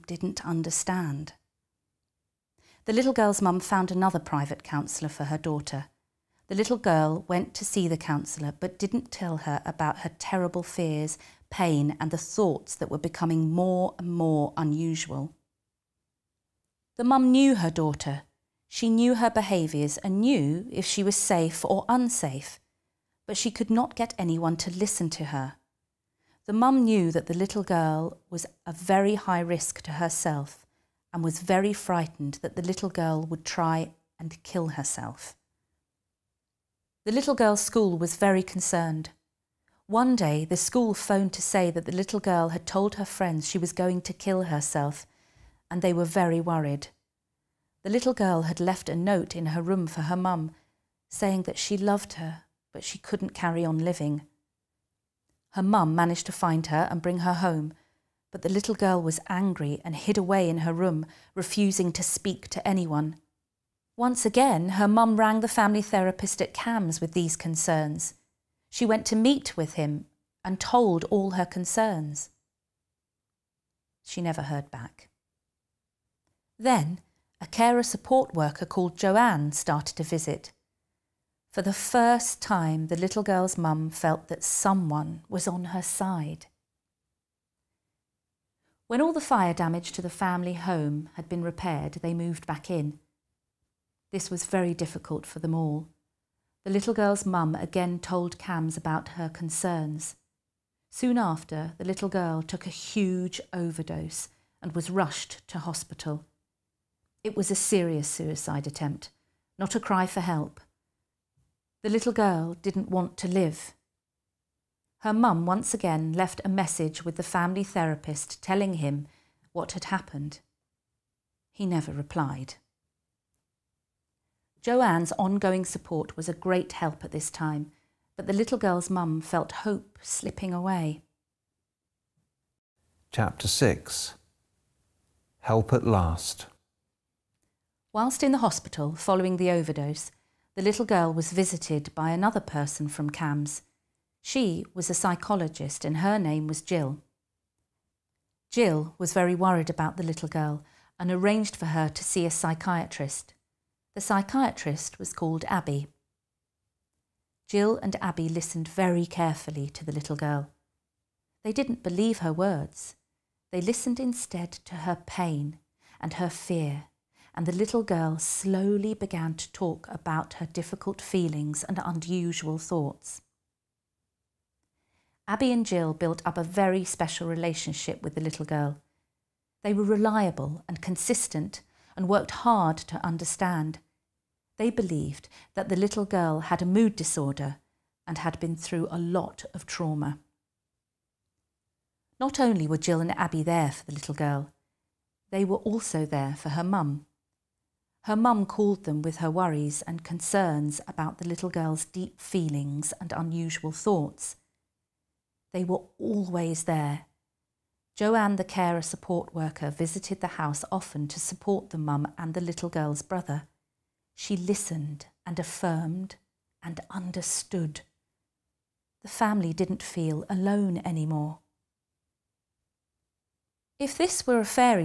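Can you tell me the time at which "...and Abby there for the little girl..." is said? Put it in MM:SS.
03:13.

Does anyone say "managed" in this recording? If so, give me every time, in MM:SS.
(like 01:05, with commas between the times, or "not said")
00:55.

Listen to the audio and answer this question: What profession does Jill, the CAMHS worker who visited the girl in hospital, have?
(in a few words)
Psychologist.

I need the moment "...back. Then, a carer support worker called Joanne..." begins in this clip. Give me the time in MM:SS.
01:14.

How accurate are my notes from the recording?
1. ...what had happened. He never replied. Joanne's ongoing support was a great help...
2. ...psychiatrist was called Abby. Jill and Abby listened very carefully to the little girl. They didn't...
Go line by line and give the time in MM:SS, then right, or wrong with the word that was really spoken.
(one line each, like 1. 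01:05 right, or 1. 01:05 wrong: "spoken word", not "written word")
1. 01:59 right
2. 02:34 right.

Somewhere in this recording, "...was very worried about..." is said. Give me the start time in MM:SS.
02:28.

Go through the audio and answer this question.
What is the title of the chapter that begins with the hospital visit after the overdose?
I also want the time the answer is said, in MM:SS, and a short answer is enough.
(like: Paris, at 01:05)
Help at Last, at 02:15.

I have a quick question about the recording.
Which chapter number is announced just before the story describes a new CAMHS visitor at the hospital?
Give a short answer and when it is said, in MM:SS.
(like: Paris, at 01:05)
6, at 02:13.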